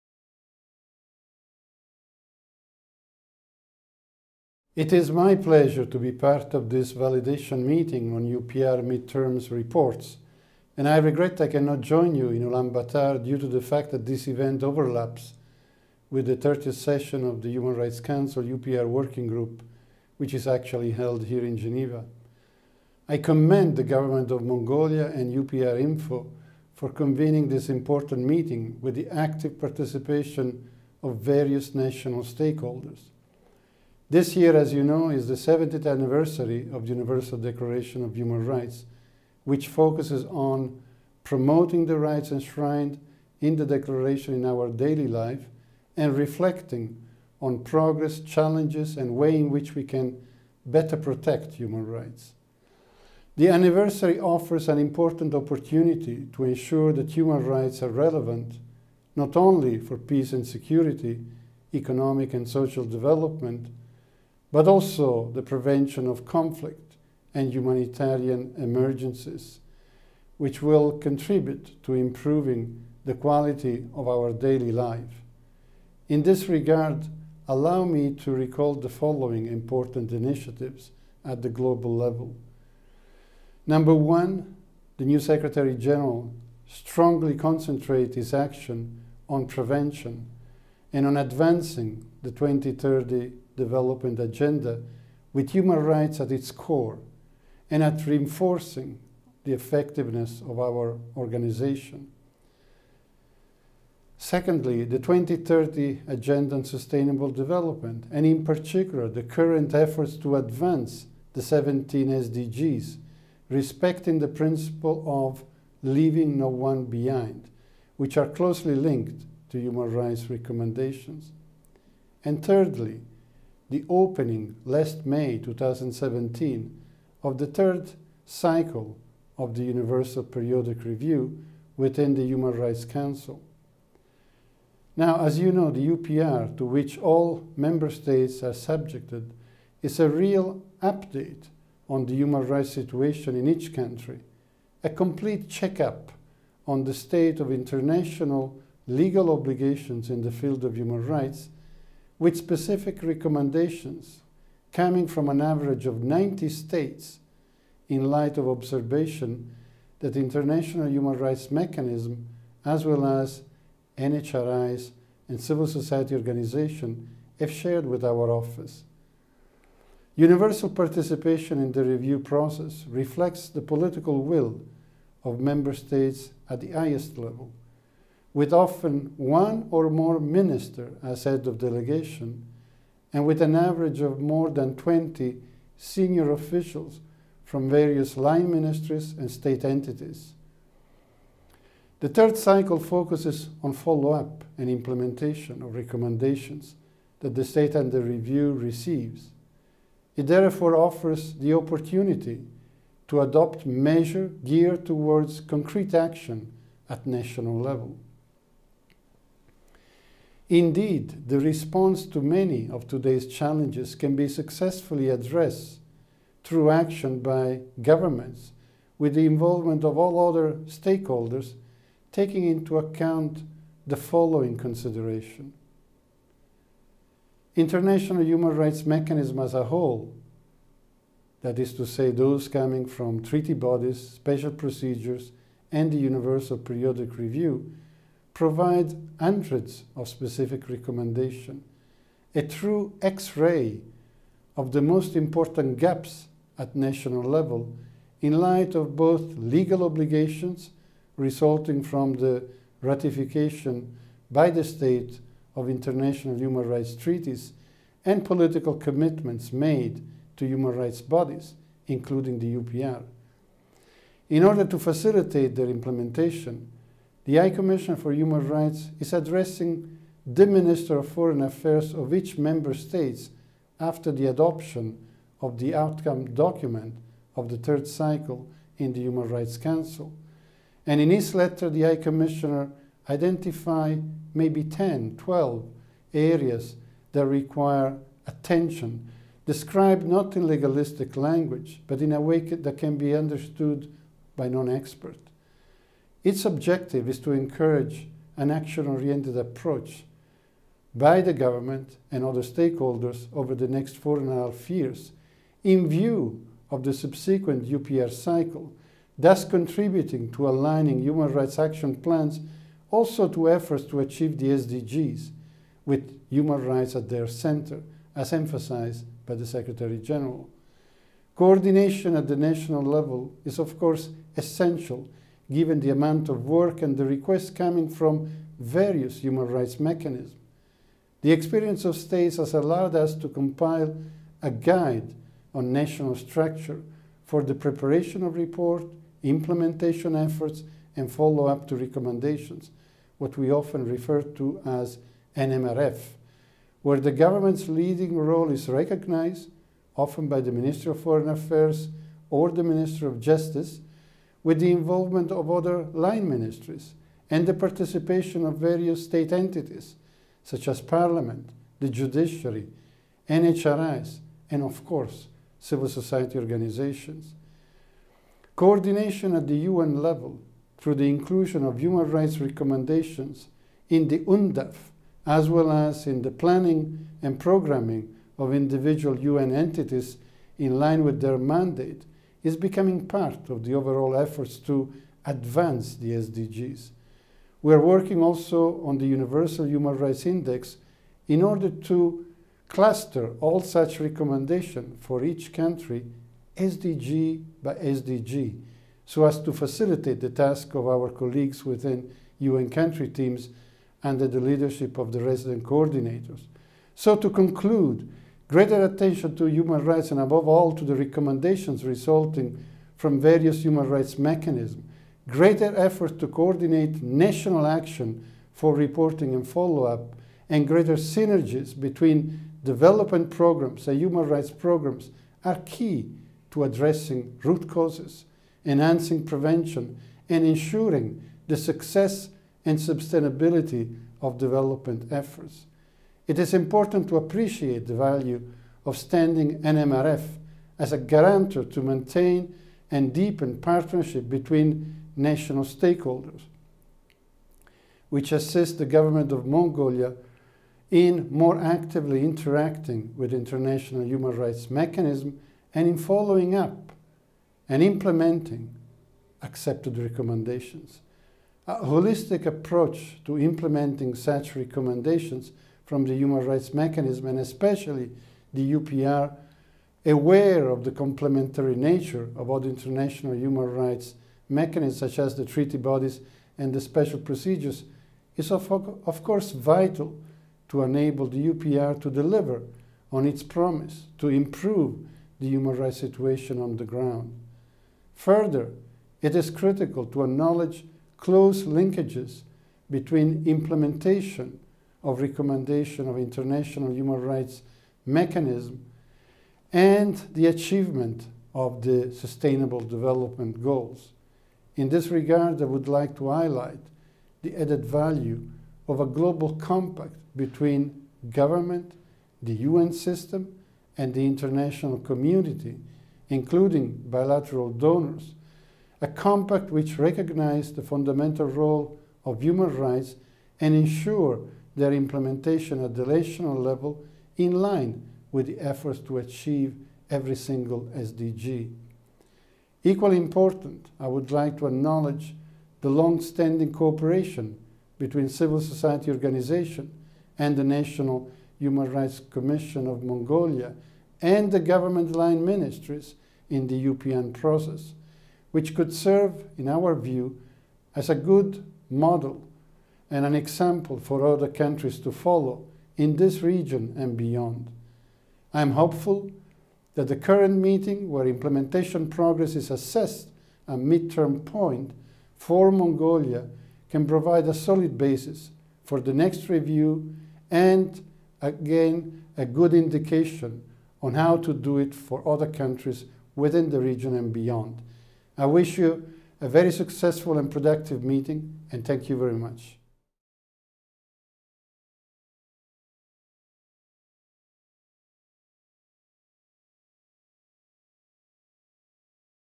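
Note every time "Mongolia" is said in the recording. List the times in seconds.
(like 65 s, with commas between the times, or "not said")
24 s, 449 s, 543 s, 565 s.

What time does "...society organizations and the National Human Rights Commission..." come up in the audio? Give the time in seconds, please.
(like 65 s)
538 s.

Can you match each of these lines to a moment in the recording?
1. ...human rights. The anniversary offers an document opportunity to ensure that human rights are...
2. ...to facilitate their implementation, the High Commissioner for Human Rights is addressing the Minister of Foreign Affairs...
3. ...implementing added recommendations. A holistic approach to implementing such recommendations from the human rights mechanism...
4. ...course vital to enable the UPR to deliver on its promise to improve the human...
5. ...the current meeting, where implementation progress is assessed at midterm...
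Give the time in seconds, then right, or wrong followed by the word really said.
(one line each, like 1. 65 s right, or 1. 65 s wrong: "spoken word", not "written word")
1. 51 s wrong: "important", not "document"
2. 264 s right
3. 457 s wrong: "accepted", not "added"
4. 479 s right
5. 560 s right.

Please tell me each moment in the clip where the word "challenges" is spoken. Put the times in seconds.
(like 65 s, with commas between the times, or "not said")
48 s, 213 s.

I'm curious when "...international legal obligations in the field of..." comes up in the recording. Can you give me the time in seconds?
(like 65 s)
147 s.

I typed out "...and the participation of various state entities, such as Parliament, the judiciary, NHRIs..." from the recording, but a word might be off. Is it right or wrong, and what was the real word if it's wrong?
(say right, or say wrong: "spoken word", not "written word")
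right.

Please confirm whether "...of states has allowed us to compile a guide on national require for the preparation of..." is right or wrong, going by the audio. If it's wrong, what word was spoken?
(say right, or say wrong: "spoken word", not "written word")
wrong: "structure", not "require".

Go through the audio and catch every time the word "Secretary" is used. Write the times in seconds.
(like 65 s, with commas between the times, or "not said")
85 s, 319 s.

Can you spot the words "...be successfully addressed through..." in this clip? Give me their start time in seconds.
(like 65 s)
214 s.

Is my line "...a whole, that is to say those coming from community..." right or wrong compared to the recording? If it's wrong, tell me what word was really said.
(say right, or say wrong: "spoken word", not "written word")
wrong: "treaty", not "community".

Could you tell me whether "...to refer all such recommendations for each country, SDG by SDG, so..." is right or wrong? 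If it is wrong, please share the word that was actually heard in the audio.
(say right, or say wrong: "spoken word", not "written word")
wrong: "cluster", not "refer".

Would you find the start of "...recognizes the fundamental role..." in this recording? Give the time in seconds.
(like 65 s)
519 s.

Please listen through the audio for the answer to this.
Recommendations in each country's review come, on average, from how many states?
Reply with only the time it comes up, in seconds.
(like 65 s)
156 s.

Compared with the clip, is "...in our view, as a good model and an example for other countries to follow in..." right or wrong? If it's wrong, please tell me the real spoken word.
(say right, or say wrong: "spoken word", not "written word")
right.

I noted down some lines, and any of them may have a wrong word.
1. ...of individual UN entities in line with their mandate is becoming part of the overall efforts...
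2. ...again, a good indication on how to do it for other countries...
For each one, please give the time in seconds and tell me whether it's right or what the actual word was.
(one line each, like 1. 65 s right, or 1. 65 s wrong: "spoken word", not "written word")
1. 378 s right
2. 571 s right.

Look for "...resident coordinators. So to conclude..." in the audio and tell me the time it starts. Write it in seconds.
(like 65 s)
405 s.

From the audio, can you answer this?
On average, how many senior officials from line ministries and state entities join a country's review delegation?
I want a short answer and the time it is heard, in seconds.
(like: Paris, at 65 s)
more than 20, at 184 s.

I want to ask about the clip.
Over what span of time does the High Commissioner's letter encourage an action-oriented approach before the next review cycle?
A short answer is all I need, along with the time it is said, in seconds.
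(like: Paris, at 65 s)
4 and a half years, at 303 s.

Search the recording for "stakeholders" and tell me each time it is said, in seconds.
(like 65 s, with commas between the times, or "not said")
32 s, 220 s, 302 s, 445 s.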